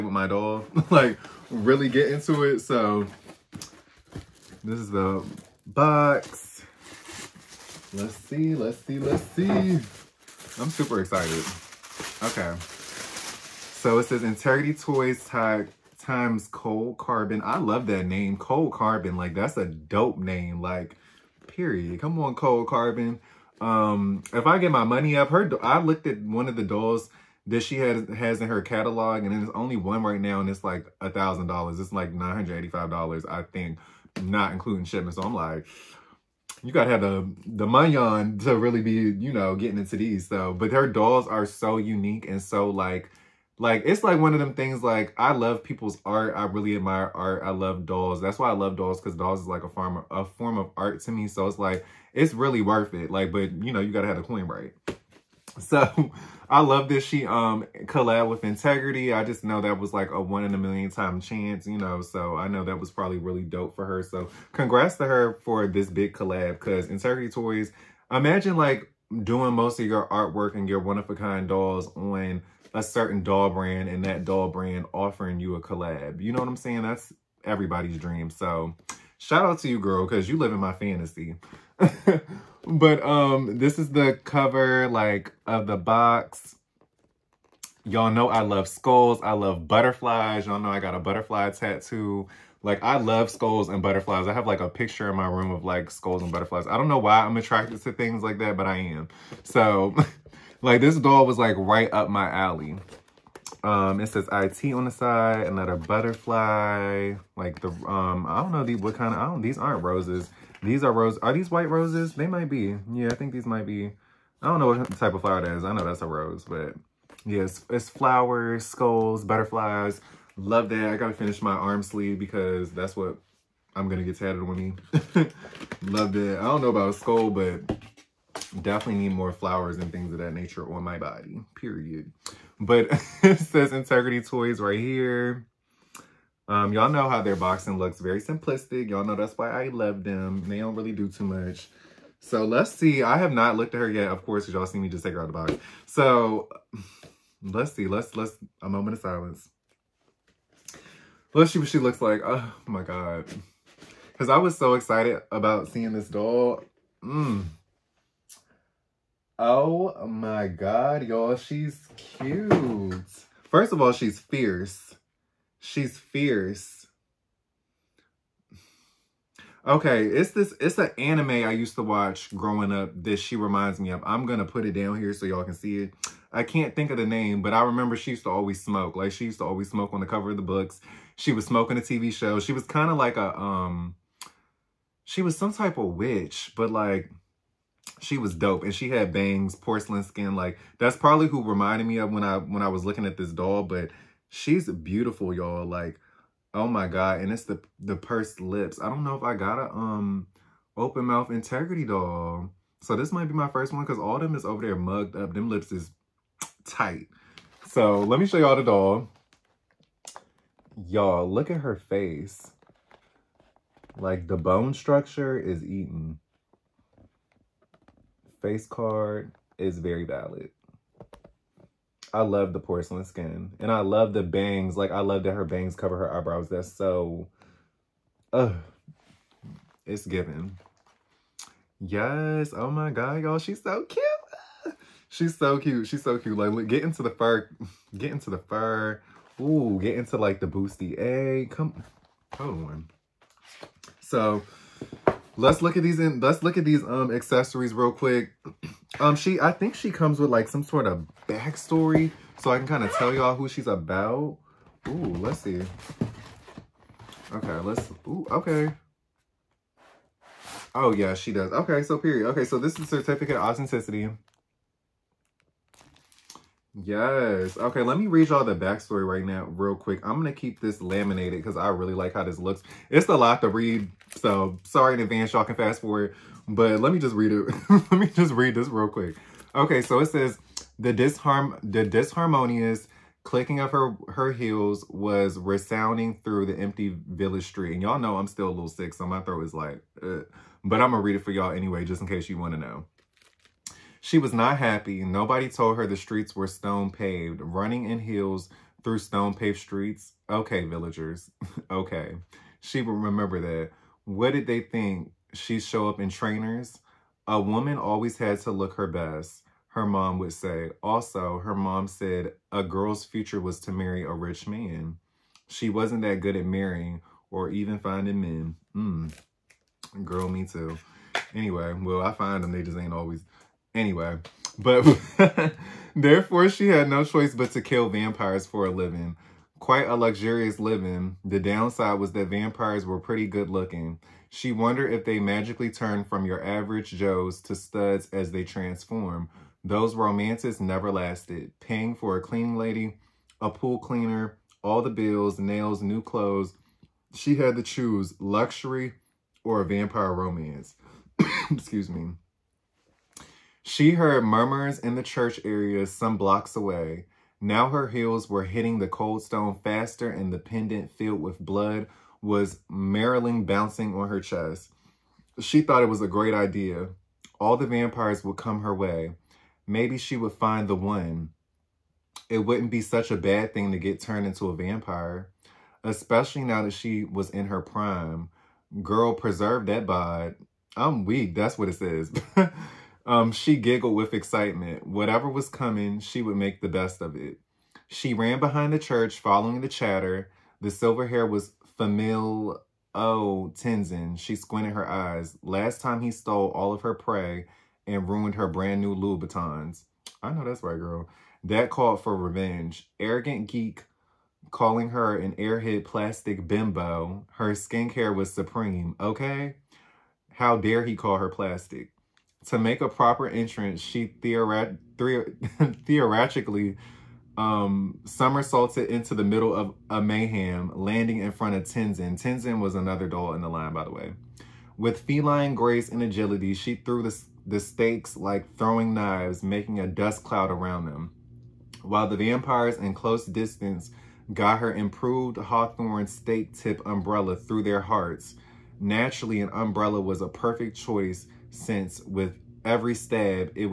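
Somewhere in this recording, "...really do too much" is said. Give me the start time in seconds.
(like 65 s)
140 s.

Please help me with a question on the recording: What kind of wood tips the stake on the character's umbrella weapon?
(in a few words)
hawthorn.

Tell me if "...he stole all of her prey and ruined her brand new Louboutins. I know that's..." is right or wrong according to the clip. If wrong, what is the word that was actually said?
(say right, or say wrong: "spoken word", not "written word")
right.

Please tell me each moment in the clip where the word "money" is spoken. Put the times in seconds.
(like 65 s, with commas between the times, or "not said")
24 s, 37 s.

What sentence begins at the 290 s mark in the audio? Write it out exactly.
but I'm gonna read it for y'all anyway, just in case you want to know.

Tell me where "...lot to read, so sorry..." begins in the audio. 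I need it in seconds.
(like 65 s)
273 s.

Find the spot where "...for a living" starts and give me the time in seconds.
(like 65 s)
328 s.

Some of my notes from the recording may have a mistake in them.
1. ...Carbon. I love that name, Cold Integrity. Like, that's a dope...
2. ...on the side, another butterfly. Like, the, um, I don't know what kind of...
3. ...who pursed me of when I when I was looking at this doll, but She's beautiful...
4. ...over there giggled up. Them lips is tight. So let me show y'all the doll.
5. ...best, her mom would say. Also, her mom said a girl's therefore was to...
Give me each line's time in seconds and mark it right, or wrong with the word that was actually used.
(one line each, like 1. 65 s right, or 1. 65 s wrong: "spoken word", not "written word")
1. 16 s wrong: "Carbon", not "Integrity"
2. 104 s right
3. 191 s wrong: "reminded", not "pursed"
4. 204 s wrong: "mugged", not "giggled"
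5. 308 s wrong: "future", not "therefore".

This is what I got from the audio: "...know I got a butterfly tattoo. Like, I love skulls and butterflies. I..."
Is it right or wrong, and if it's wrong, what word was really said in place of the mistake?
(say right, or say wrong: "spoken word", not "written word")
right.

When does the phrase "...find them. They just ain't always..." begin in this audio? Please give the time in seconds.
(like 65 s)
322 s.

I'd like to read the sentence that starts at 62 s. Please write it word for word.
So I know that was probably really dope for her.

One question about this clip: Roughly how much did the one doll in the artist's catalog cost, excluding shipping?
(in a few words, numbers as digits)
$985.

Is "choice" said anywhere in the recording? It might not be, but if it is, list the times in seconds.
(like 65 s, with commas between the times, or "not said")
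327 s, 440 s.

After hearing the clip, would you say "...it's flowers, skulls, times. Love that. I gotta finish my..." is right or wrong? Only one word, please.
wrong.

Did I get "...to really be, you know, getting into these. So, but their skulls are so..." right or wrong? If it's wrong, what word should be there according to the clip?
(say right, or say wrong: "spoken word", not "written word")
wrong: "dolls", not "skulls".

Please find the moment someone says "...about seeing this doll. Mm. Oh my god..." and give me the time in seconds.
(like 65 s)
155 s.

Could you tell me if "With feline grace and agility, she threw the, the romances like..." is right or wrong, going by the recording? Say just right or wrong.
wrong.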